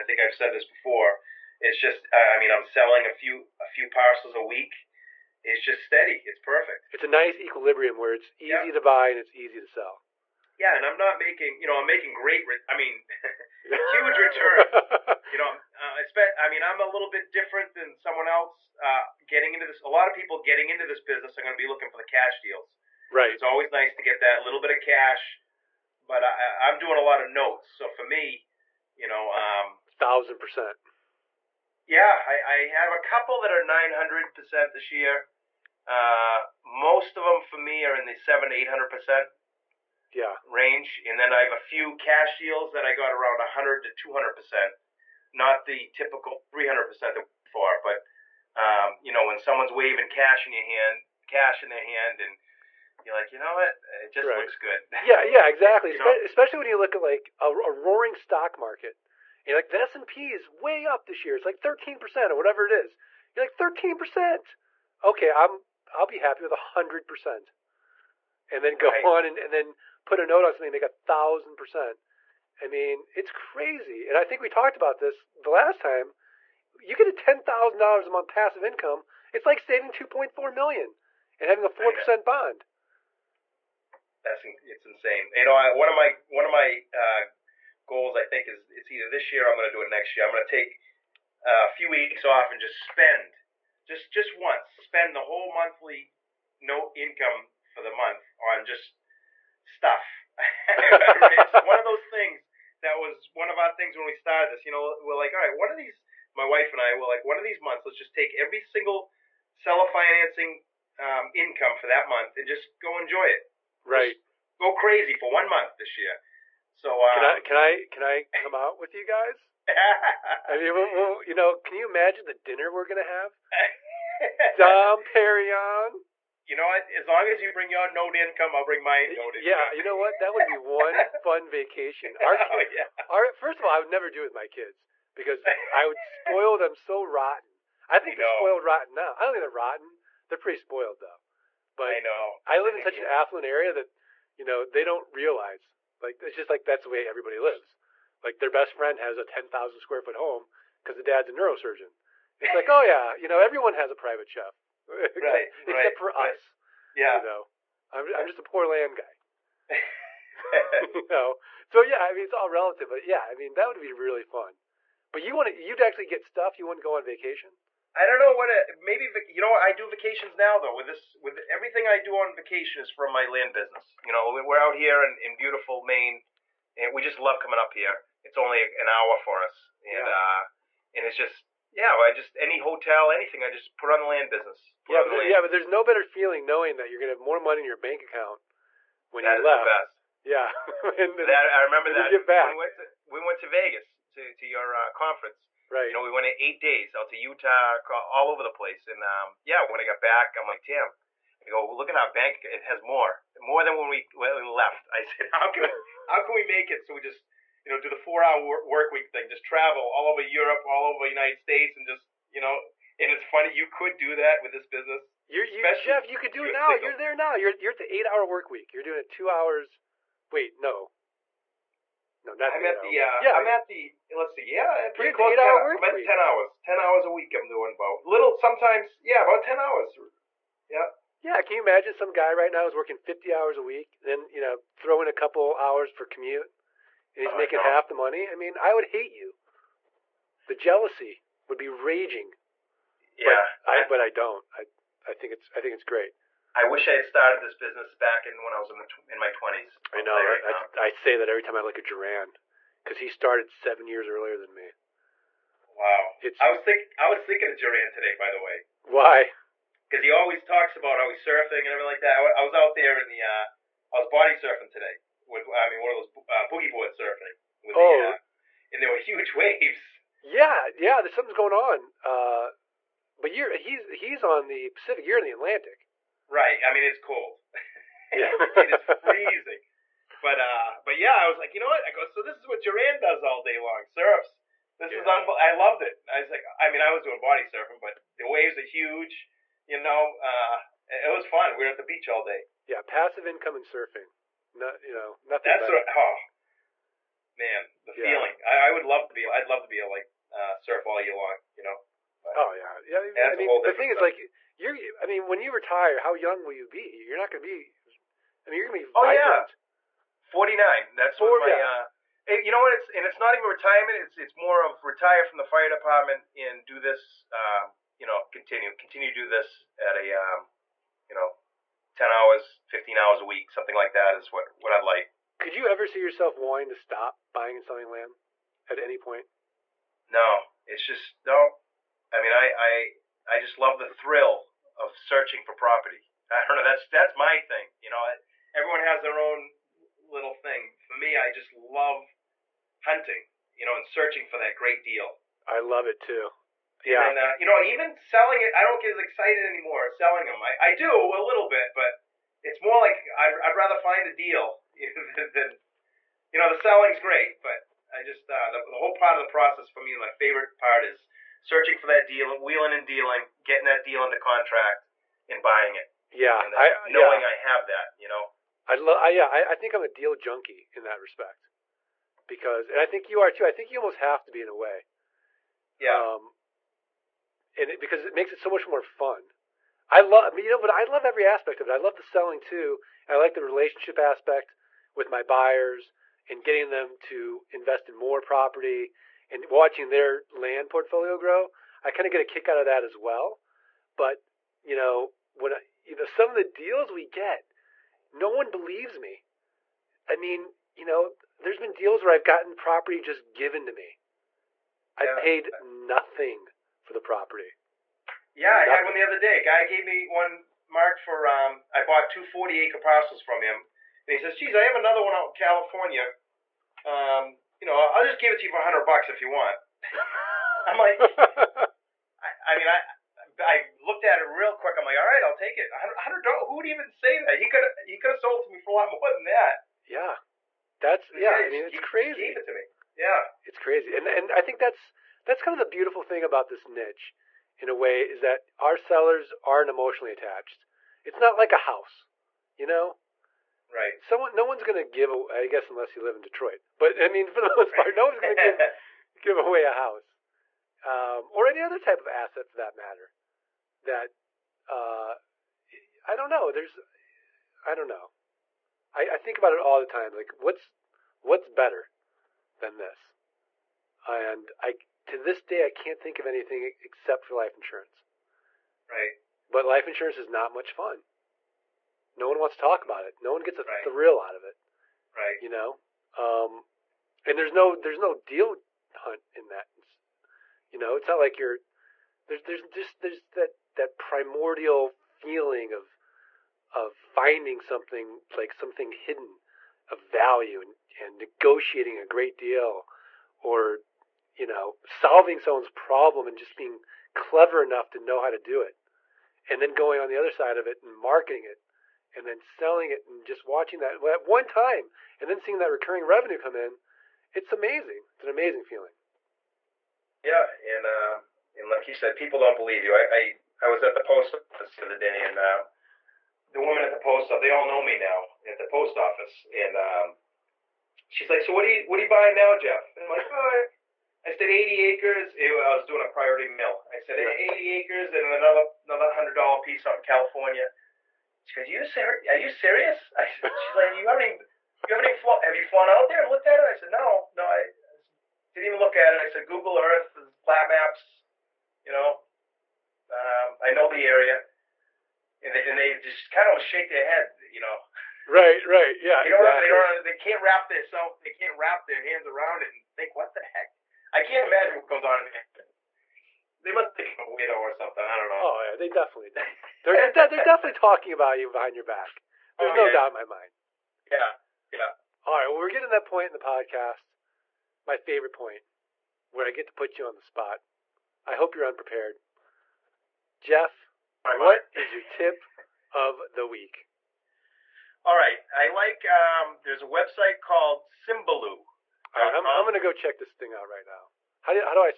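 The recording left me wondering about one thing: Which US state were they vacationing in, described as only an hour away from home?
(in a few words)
Maine.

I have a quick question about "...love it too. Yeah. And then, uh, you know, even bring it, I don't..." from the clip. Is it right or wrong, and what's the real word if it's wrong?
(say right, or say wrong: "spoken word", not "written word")
wrong: "selling", not "bring".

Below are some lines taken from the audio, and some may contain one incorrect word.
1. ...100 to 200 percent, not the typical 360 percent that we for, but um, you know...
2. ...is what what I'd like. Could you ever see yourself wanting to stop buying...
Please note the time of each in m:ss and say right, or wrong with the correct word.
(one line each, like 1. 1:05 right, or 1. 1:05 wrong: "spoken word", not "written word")
1. 0:43 wrong: "300", not "360"
2. 5:24 right.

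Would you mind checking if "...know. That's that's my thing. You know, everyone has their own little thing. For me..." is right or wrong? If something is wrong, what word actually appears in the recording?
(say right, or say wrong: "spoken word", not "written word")
right.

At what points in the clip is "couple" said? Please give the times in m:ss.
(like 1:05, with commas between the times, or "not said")
0:32, 3:55.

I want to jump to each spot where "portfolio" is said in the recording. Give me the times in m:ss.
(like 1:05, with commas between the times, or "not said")
6:30.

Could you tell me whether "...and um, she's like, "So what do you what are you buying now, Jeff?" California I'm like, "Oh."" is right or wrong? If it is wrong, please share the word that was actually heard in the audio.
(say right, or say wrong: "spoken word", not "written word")
wrong: "And", not "California".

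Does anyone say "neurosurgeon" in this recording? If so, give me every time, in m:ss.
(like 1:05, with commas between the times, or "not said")
2:31.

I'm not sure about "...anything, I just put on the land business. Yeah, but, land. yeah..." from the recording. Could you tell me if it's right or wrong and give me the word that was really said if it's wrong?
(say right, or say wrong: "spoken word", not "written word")
right.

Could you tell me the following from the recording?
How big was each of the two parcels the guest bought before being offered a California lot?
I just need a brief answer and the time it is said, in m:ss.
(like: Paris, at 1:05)
40 acres, at 6:52.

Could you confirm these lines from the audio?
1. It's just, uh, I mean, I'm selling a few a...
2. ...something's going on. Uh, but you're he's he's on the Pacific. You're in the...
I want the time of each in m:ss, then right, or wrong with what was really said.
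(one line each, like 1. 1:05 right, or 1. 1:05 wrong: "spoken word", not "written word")
1. 0:01 right
2. 4:31 right.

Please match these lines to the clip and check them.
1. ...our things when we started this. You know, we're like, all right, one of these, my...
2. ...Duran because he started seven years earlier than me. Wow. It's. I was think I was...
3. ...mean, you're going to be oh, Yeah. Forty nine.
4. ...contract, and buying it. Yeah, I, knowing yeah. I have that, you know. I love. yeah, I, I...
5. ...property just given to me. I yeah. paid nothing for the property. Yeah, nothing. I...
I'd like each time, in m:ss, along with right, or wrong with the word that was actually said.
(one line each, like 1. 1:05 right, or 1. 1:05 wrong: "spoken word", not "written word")
1. 1:43 right
2. 4:11 right
3. 5:08 right
4. 6:04 right
5. 6:42 right.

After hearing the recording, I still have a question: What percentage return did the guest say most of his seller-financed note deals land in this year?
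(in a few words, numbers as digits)
700 to 800 percent.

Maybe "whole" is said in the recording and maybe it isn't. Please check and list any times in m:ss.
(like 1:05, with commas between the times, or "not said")
1:35, 5:58.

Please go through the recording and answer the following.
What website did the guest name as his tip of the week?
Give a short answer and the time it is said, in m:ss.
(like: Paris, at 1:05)
Symbaloo, at 9:40.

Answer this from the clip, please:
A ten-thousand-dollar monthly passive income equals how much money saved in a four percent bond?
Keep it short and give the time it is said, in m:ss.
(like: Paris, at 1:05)
2.4 million, at 1:19.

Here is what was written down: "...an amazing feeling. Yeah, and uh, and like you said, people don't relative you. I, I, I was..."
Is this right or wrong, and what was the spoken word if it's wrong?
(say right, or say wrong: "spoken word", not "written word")
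wrong: "believe", not "relative".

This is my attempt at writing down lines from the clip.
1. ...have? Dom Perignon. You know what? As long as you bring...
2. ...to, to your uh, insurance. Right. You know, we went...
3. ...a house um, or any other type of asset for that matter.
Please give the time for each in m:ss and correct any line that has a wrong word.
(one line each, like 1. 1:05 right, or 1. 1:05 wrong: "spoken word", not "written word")
1. 2:03 right
2. 3:14 wrong: "conference", not "insurance"
3. 7:29 right.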